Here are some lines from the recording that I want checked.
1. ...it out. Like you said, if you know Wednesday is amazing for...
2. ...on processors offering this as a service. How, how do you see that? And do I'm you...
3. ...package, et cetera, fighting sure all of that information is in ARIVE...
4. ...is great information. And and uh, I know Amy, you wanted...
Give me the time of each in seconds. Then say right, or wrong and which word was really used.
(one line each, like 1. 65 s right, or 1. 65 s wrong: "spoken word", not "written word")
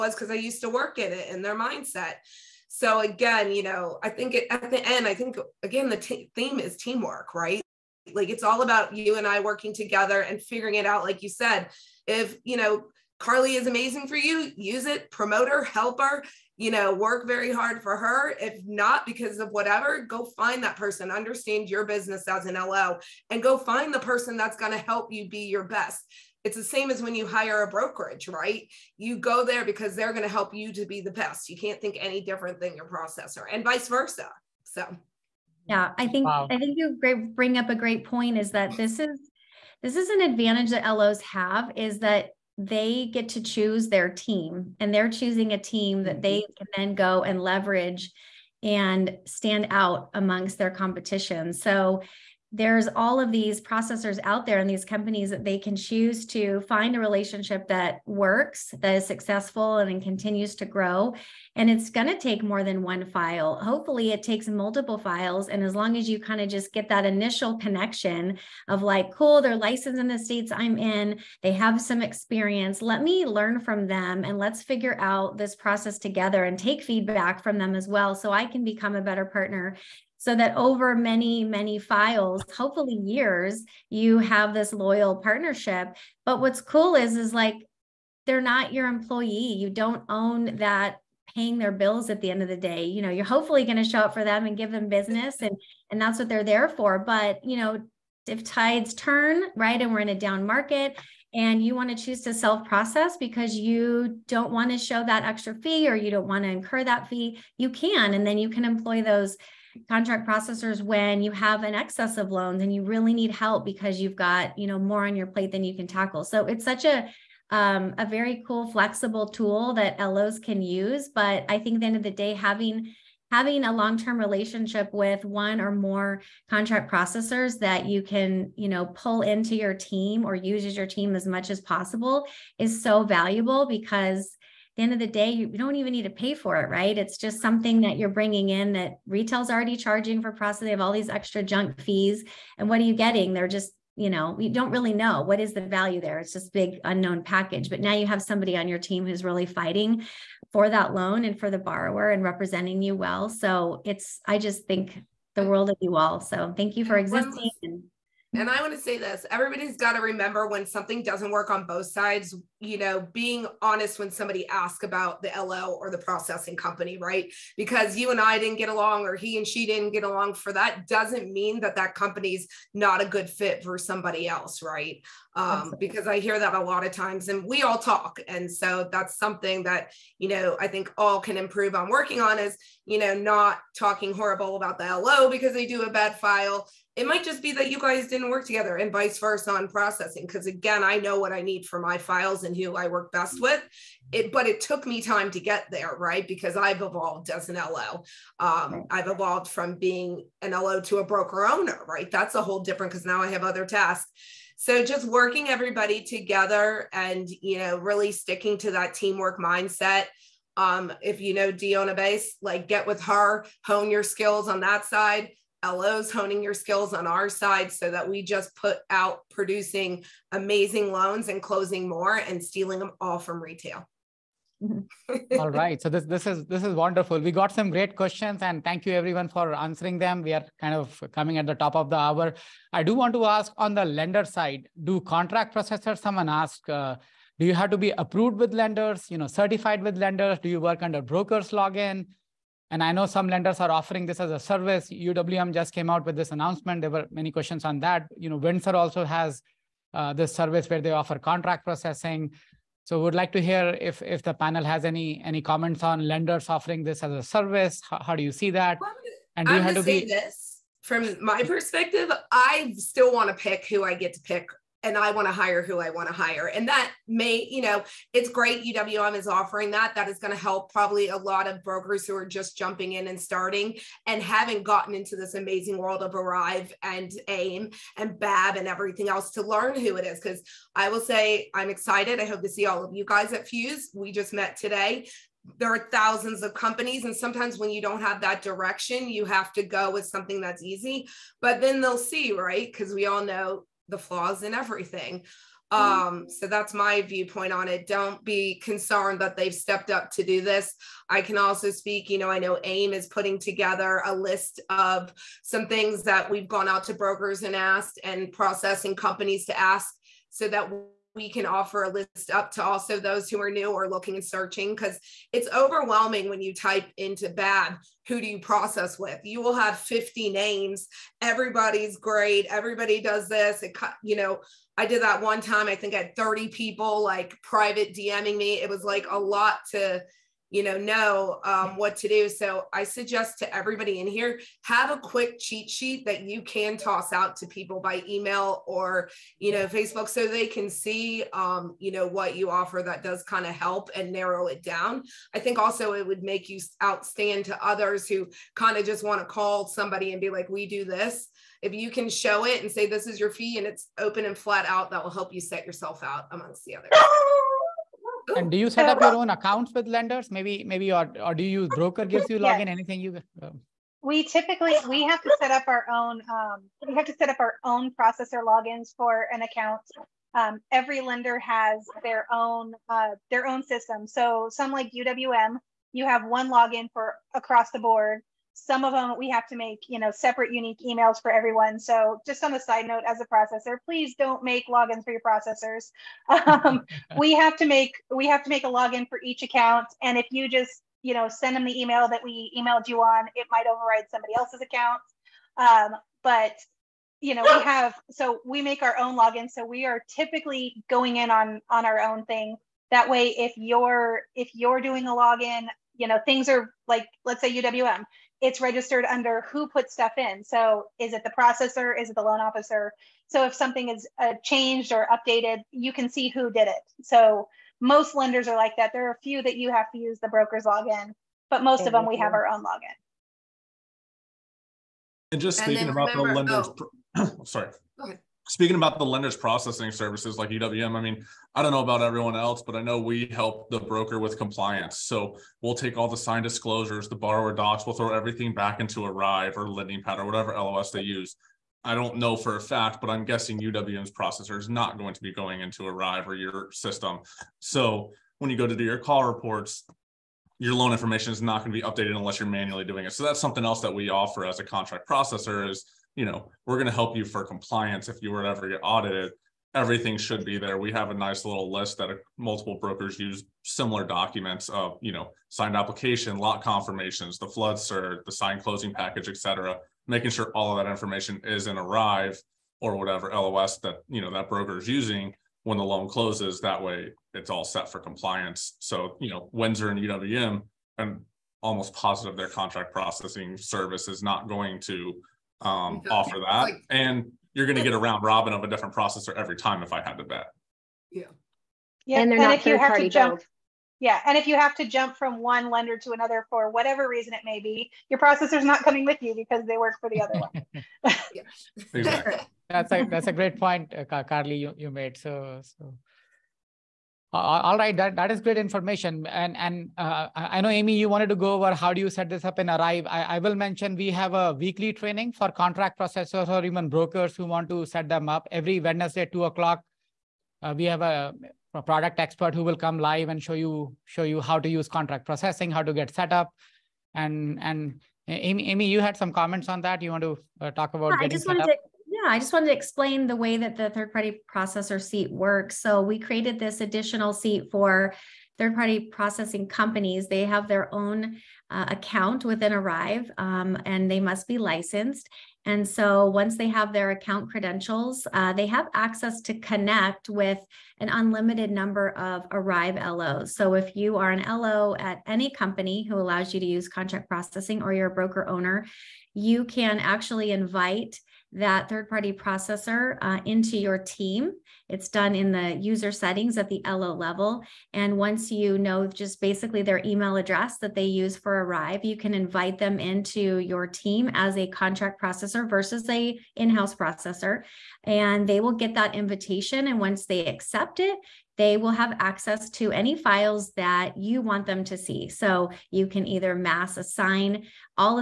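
1. 10 s wrong: "Carly", not "Wednesday"
2. 255 s wrong: "lenders", not "processors"
3. 468 s wrong: "making", not "fighting"
4. 508 s right.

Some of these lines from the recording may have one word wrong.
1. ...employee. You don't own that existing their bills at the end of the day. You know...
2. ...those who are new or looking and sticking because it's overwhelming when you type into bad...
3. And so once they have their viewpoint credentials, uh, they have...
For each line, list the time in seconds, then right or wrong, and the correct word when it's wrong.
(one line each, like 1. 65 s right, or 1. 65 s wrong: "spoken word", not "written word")
1. 88 s wrong: "paying", not "existing"
2. 312 s wrong: "searching", not "sticking"
3. 545 s wrong: "account", not "viewpoint".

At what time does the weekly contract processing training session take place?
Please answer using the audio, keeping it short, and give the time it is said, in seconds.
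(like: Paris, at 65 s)
2:00, at 519 s.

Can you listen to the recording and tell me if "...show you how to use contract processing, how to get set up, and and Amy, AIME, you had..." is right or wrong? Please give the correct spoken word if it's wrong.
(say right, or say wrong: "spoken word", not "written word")
wrong: "Amy", not "AIME".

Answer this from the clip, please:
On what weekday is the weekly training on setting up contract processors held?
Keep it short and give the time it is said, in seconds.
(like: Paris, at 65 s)
Wednesday, at 518 s.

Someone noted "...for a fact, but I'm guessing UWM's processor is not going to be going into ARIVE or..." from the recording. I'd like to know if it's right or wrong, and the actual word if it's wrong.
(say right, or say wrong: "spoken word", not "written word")
right.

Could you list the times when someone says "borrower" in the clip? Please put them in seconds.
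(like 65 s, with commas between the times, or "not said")
151 s, 437 s.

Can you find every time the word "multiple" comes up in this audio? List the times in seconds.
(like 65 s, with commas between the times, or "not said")
64 s, 462 s.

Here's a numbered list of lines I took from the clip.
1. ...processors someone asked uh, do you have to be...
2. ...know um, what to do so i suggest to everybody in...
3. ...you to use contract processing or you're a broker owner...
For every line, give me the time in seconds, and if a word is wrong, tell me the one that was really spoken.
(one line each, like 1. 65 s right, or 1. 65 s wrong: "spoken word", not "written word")
1. 235 s right
2. 330 s right
3. 556 s right.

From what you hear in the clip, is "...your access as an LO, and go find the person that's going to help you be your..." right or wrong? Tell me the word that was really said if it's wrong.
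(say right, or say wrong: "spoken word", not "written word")
wrong: "business", not "access".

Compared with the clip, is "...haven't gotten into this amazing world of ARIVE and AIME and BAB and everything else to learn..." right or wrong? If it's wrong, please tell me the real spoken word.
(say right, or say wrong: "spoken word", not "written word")
right.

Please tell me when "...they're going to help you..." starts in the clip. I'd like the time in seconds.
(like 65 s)
29 s.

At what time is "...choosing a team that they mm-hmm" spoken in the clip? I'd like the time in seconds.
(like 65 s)
45 s.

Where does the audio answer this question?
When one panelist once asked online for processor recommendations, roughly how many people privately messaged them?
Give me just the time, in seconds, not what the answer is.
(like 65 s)
326 s.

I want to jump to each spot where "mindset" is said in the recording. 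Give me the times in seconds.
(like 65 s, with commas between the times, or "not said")
1 s, 209 s.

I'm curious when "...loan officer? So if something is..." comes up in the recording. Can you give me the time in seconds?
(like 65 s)
412 s.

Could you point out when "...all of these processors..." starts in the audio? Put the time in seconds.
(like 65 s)
52 s.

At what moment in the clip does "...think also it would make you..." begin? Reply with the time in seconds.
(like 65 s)
345 s.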